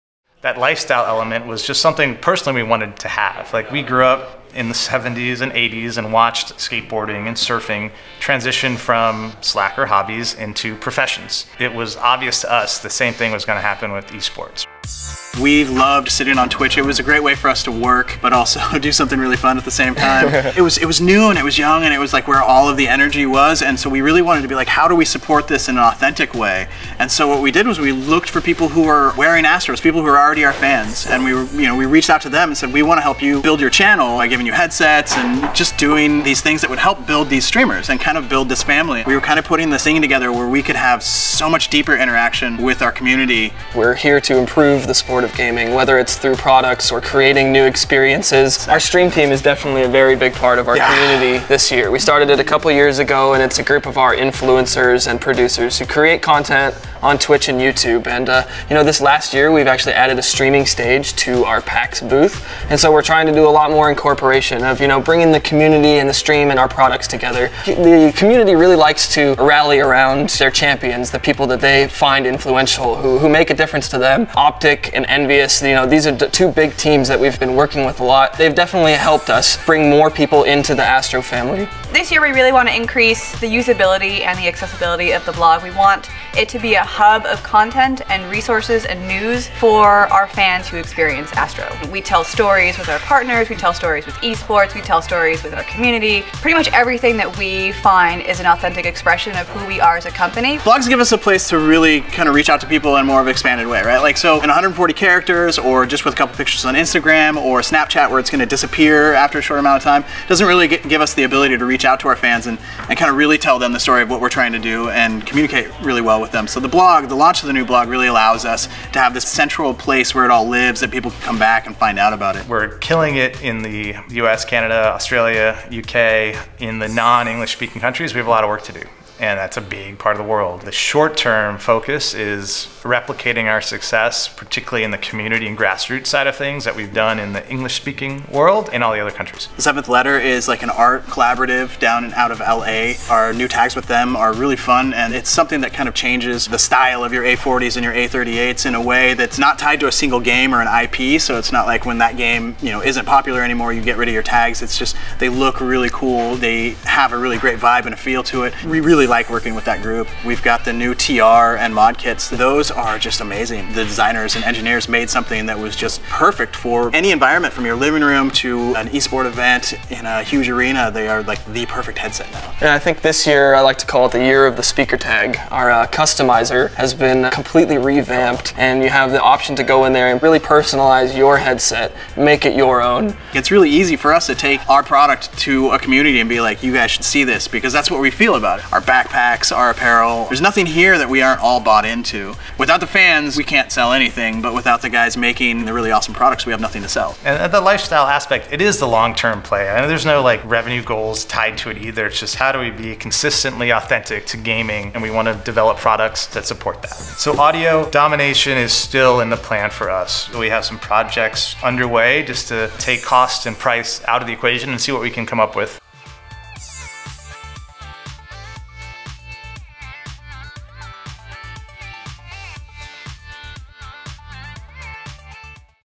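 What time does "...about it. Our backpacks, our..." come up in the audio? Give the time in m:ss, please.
3:08.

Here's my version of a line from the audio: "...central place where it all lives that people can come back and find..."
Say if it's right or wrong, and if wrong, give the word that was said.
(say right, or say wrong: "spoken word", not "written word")
right.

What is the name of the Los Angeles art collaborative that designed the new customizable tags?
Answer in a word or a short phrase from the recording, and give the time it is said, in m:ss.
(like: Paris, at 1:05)
The Seventh Letter, at 2:19.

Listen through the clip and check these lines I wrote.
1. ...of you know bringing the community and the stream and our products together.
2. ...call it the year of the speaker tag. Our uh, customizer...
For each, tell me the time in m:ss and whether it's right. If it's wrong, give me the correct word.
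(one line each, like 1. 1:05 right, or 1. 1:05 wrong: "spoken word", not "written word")
1. 1:04 right
2. 2:53 right.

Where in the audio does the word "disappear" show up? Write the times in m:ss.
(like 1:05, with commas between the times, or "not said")
1:48.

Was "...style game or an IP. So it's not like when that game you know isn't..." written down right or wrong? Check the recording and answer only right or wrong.
wrong.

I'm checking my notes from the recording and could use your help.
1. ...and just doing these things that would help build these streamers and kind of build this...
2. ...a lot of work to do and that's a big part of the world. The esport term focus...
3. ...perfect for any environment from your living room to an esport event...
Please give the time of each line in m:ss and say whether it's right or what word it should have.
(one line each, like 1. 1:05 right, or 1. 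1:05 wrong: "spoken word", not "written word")
1. 0:35 right
2. 2:08 wrong: "short", not "esport"
3. 2:46 right.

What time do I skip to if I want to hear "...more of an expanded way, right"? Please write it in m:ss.
1:43.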